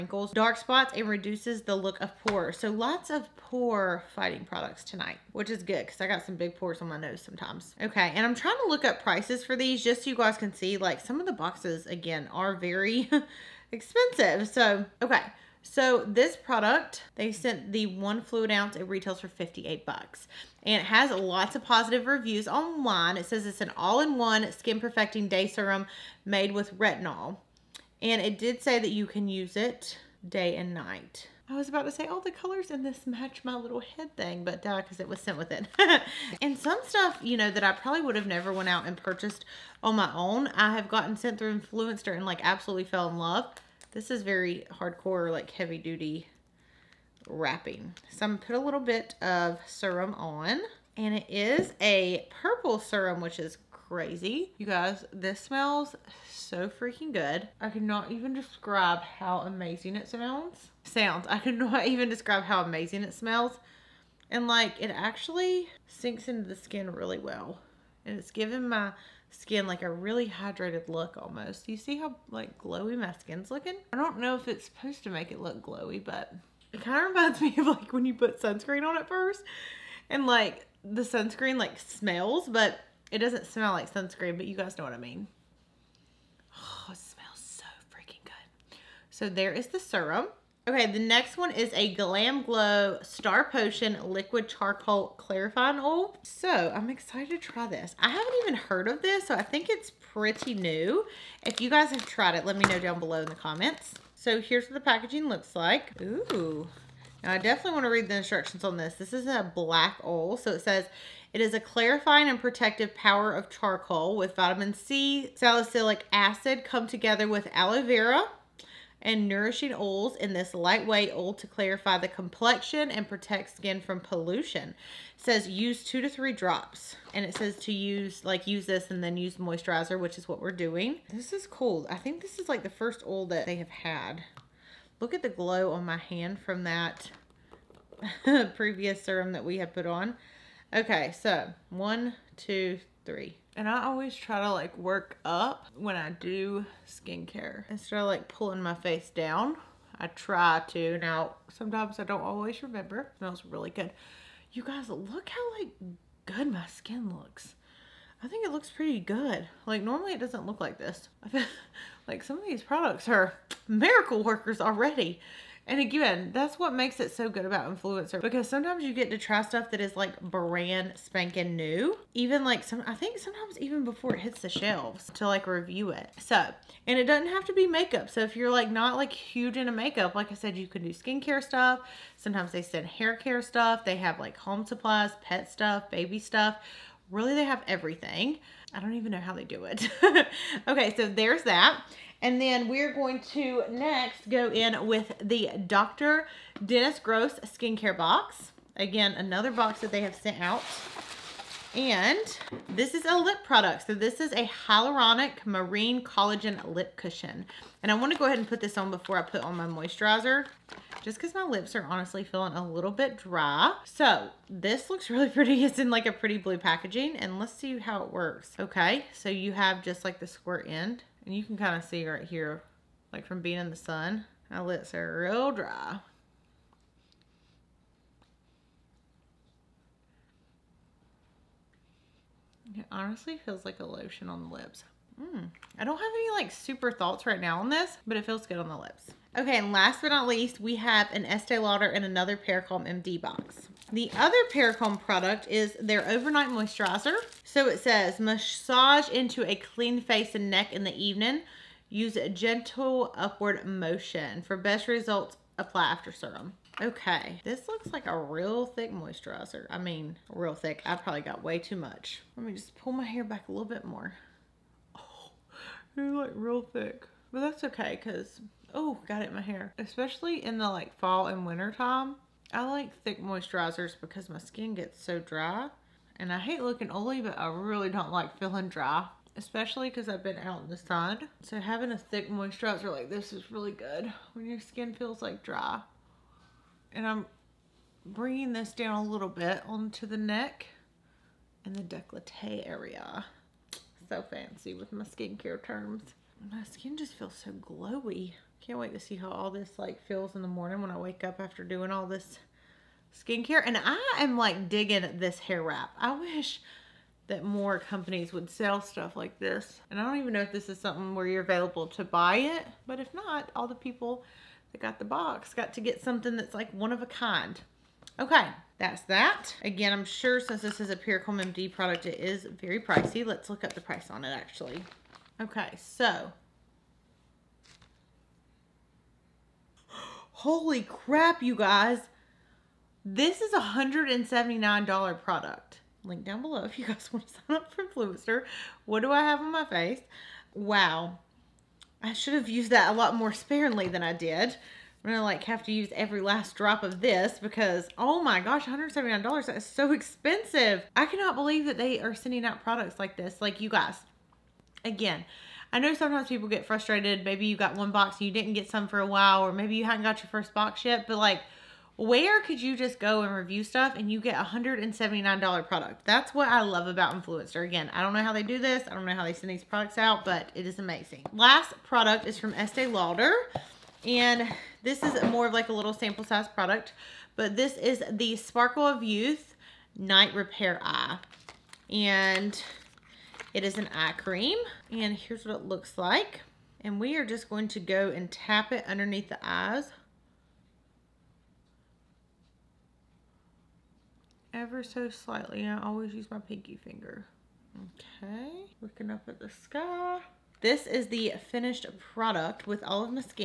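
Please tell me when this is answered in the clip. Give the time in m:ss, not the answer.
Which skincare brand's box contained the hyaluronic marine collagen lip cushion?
3:15.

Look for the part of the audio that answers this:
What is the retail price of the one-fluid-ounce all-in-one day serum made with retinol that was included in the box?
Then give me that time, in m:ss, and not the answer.
0:19.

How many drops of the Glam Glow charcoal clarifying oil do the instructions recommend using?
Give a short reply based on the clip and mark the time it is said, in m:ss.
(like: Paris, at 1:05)
2 to 3, at 2:05.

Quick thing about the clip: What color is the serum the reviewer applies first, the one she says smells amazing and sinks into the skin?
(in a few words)
Purple.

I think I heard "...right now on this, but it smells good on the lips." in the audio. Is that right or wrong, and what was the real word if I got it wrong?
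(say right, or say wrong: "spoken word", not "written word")
wrong: "feels", not "smells".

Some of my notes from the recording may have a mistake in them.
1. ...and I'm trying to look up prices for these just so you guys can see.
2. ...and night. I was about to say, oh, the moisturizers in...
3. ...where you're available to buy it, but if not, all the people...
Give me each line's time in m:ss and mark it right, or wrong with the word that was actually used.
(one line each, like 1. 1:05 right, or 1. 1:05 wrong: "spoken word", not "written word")
1. 0:08 right
2. 0:30 wrong: "colors", not "moisturizers"
3. 5:11 right.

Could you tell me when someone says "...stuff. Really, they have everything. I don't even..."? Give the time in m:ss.
3:06.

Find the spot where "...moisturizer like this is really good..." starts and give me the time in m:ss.
4:42.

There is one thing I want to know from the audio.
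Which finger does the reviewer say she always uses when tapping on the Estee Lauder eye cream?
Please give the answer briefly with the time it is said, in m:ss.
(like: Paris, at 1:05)
Pinky finger, at 6:36.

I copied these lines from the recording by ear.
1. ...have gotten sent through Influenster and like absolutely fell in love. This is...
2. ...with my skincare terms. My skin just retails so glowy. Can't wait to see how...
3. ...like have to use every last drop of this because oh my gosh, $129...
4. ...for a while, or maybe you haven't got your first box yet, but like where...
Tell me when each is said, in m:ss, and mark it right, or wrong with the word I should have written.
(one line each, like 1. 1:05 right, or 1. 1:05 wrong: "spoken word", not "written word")
1. 0:40 right
2. 4:54 wrong: "feels", not "retails"
3. 5:45 wrong: "179", not "129"
4. 5:58 right.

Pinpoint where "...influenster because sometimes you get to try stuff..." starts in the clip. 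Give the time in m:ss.
2:47.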